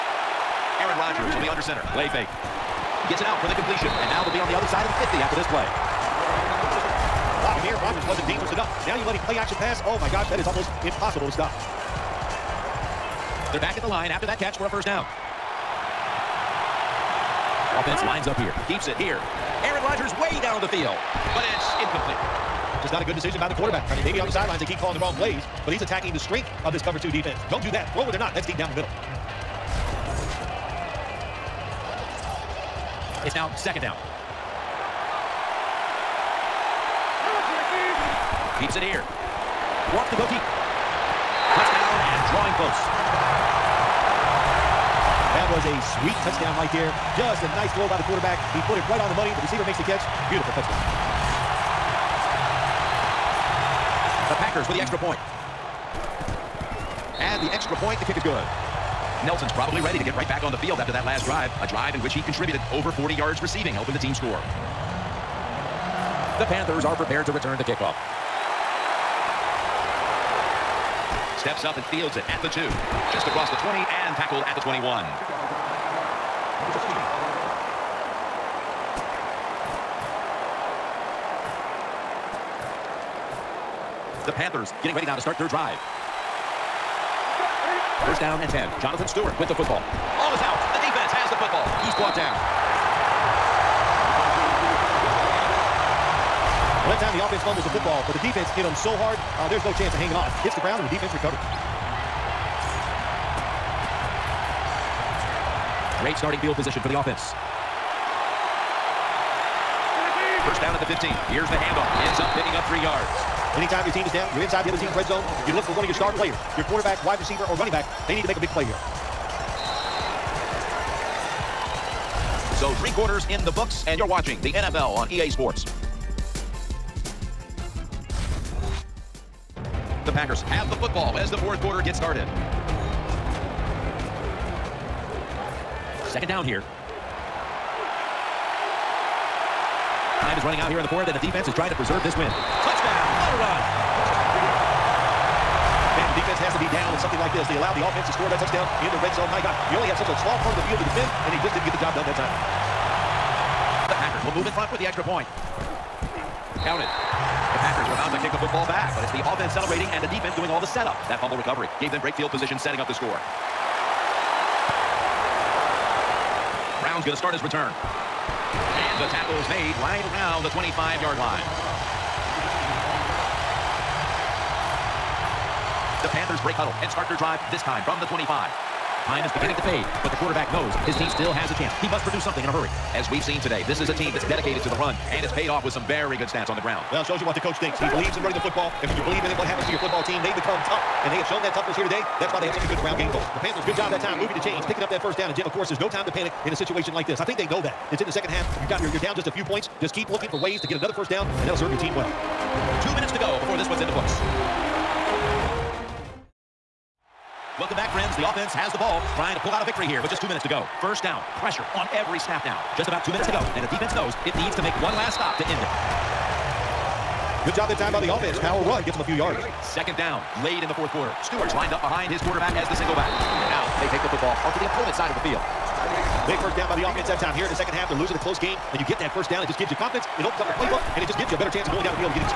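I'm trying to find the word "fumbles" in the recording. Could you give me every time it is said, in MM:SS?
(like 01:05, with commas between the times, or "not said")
01:37, 02:41.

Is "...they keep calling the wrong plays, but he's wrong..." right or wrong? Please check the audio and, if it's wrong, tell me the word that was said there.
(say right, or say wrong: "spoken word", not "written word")
wrong: "attacking", not "wrong".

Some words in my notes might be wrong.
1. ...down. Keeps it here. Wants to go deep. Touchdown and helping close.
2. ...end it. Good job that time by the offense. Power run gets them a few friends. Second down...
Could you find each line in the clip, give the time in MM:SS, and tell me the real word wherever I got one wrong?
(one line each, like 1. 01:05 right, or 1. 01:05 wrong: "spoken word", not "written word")
1. 00:33 wrong: "drawing", not "helping"
2. 03:35 wrong: "yards", not "friends".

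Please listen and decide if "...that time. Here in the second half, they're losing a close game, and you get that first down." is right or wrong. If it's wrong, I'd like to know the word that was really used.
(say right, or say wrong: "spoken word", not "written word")
right.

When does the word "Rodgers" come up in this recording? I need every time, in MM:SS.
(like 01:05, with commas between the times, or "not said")
00:01, 00:07, 00:19.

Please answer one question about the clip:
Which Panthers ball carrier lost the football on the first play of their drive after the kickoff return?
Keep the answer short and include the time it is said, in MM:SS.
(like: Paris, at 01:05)
Jonathan Stewart, at 01:28.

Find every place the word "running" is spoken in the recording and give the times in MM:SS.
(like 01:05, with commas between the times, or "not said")
01:57, 02:20, 03:08.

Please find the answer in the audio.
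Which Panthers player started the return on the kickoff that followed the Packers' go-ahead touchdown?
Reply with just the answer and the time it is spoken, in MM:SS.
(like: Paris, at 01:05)
Brown, at 02:46.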